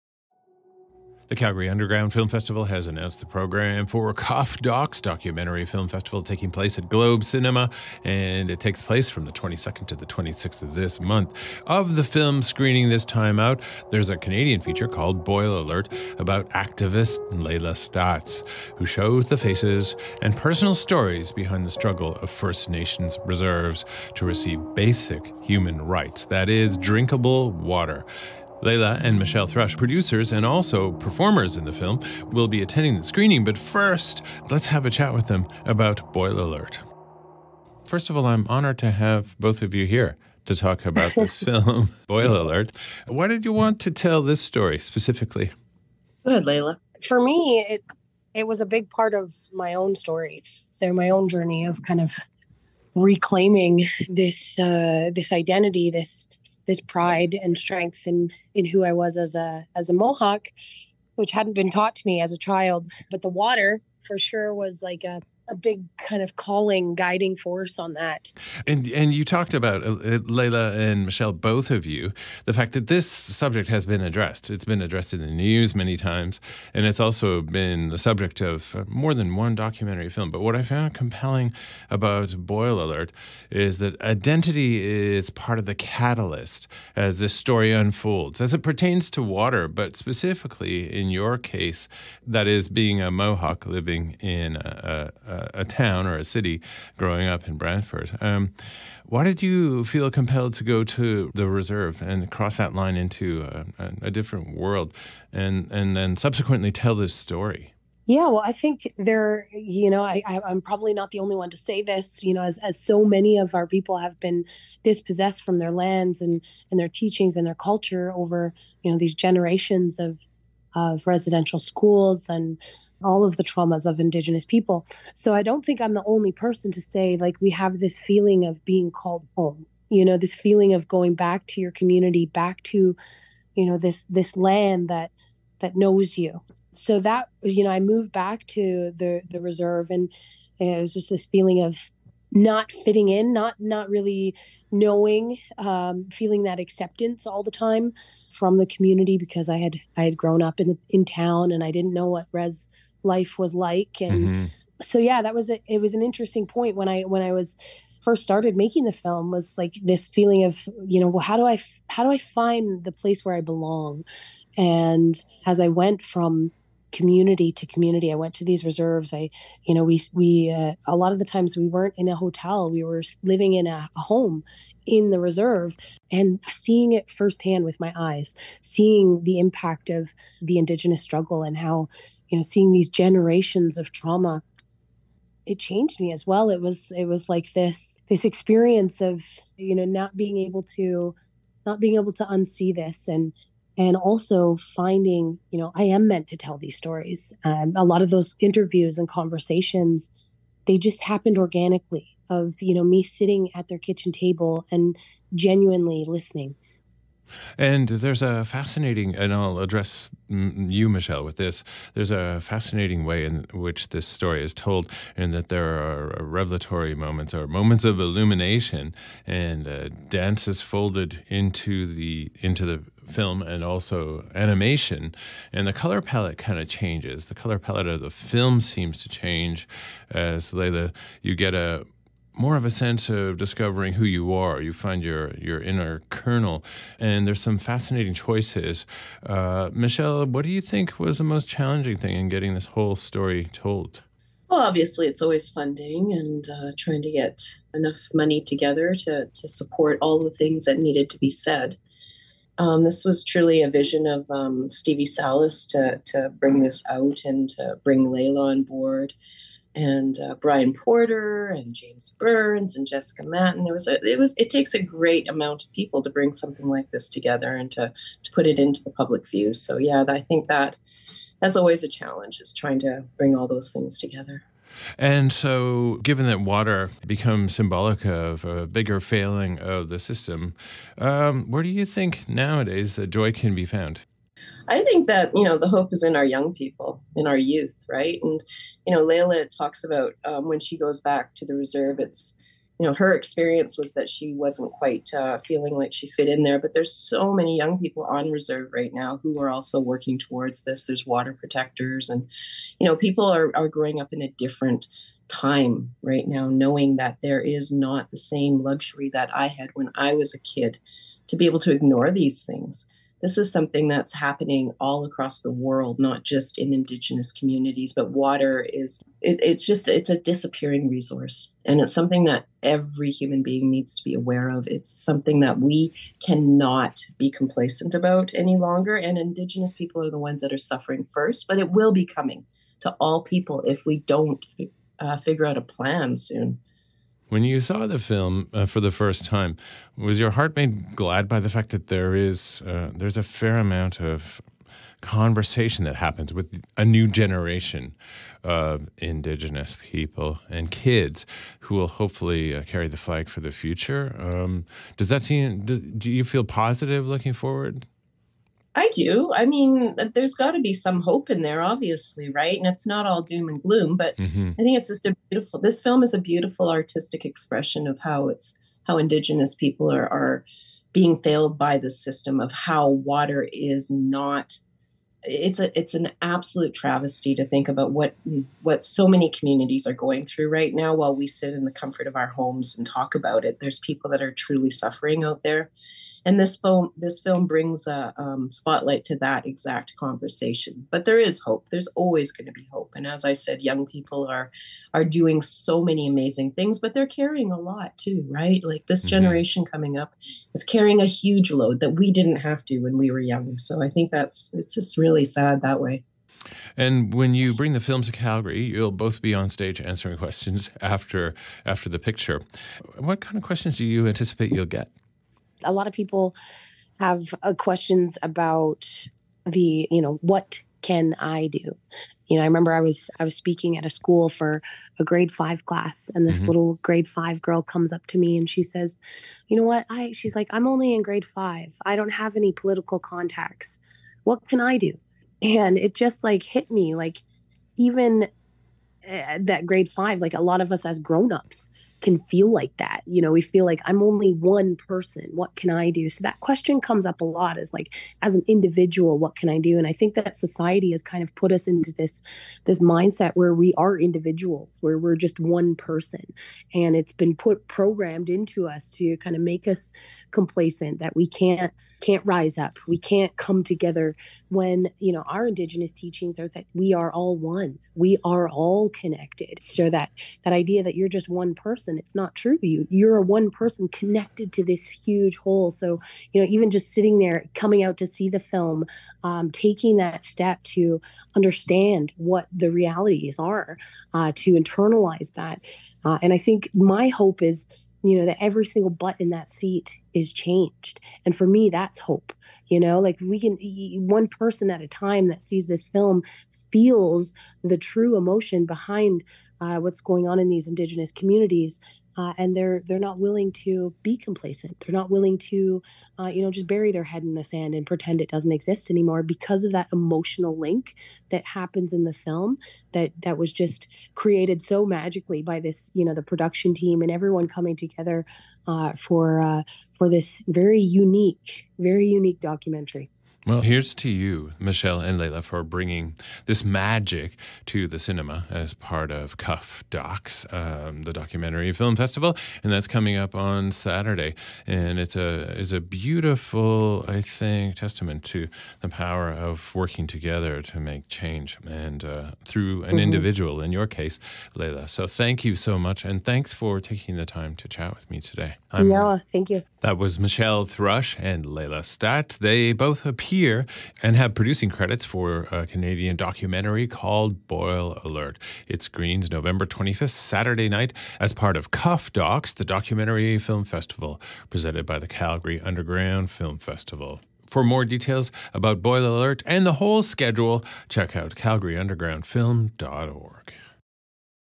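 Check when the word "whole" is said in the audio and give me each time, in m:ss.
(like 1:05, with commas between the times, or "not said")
4:02, 7:55, 9:29.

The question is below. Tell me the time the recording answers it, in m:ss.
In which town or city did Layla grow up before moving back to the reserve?
1:37.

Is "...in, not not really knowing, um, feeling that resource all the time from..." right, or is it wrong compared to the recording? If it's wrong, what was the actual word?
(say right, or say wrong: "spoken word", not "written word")
wrong: "acceptance", not "resource".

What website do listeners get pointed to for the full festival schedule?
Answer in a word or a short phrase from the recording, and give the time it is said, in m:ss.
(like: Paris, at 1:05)
calgaryundergroundfilm.org, at 9:31.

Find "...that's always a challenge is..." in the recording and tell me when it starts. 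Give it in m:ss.
4:31.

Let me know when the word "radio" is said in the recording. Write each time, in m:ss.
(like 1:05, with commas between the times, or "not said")
not said.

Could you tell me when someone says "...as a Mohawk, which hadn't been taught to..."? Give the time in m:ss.
0:59.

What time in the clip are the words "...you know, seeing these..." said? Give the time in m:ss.
3:02.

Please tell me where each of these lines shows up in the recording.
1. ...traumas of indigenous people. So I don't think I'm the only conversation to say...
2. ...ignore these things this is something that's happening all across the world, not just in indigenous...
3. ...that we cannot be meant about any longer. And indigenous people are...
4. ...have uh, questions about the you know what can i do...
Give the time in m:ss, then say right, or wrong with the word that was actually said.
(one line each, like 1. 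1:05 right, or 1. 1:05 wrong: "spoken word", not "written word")
1. 2:03 wrong: "person", not "conversation"
2. 5:11 right
3. 5:25 wrong: "complacent", not "meant"
4. 6:56 right.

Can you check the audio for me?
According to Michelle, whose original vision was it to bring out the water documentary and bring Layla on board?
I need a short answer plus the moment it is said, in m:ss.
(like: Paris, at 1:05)
Stevie Salas, at 4:14.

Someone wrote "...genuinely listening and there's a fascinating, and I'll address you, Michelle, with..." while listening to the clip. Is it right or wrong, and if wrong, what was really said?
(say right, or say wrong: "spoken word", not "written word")
right.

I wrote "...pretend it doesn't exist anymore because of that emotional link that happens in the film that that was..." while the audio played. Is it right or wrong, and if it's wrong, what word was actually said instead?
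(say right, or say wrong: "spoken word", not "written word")
right.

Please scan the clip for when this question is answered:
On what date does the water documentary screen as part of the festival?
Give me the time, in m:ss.
9:19.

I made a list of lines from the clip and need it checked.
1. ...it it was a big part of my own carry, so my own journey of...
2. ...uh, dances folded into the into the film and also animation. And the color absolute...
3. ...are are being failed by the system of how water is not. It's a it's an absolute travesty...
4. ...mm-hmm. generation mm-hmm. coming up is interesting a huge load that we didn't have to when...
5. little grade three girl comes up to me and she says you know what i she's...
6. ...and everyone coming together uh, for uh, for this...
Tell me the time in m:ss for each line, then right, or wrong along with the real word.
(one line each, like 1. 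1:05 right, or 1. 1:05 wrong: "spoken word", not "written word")
1. 0:47 wrong: "story", not "carry"
2. 3:39 wrong: "palette", not "absolute"
3. 6:09 right
4. 6:39 wrong: "carrying", not "interesting"
5. 7:06 wrong: "five", not "three"
6. 8:37 right.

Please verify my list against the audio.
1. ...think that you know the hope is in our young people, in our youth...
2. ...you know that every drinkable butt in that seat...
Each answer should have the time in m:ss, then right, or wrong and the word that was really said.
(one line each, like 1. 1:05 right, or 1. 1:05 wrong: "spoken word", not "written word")
1. 4:44 right
2. 8:08 wrong: "single", not "drinkable".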